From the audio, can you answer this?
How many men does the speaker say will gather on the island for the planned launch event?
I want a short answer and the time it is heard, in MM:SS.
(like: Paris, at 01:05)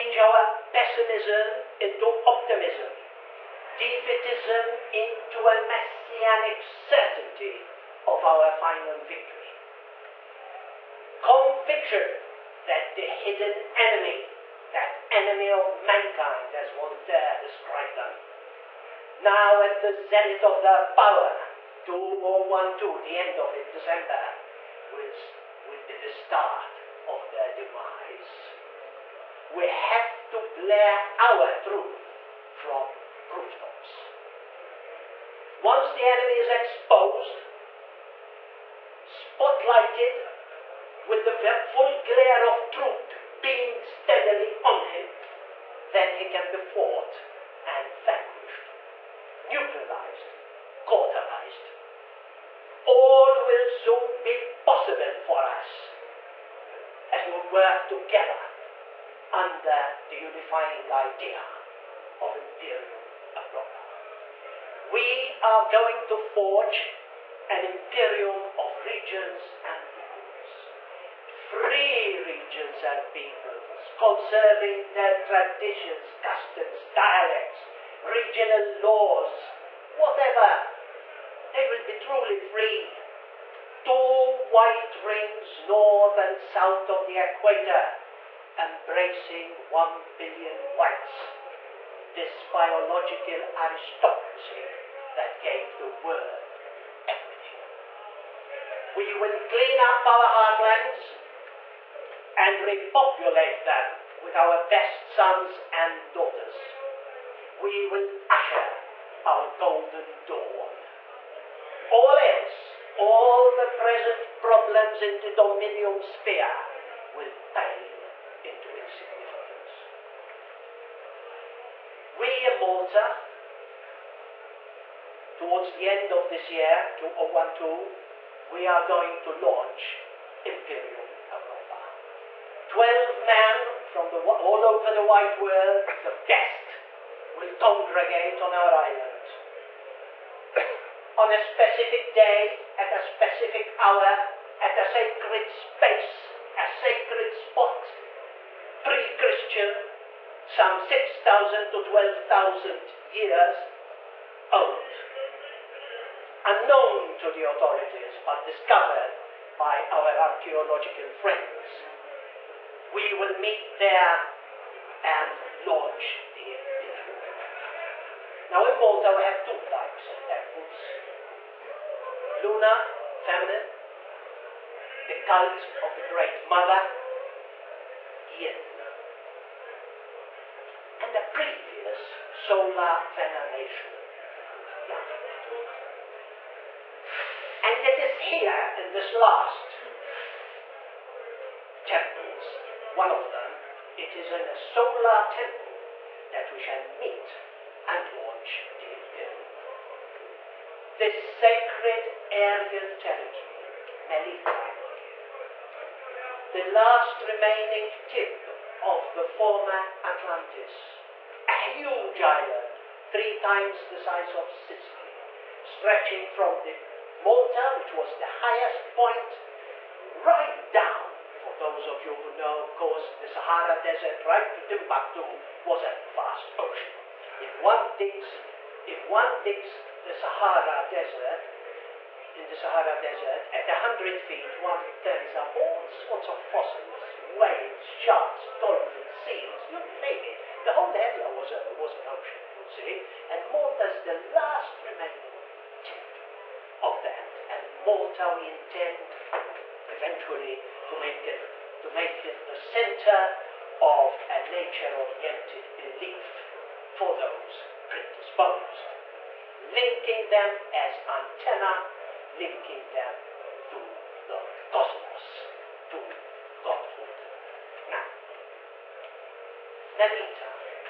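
12, at 02:12.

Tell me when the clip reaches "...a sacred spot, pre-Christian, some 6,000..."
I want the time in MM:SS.
02:26.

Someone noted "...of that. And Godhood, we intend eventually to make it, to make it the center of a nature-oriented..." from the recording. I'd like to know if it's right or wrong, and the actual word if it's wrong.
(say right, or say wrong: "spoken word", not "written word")
wrong: "Malta", not "Godhood".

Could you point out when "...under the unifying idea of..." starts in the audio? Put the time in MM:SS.
00:59.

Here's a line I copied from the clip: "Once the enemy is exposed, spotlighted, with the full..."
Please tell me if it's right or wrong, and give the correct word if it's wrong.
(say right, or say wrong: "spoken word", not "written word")
right.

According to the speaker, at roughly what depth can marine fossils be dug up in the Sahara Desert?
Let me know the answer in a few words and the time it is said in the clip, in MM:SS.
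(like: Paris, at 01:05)
100 feet, at 03:53.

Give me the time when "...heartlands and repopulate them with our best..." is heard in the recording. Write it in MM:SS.
01:40.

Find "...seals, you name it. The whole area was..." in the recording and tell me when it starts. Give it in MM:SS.
03:59.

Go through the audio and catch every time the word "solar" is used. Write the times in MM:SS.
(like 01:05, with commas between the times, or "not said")
03:02, 03:14.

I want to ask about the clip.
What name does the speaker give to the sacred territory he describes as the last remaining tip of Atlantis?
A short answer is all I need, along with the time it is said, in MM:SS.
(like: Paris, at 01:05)
Melita, at 03:24.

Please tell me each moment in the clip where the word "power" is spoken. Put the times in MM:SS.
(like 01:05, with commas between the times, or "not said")
00:20.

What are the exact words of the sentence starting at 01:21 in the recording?
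They will be truly free white rings north and south of the equator, embracing one billion whites.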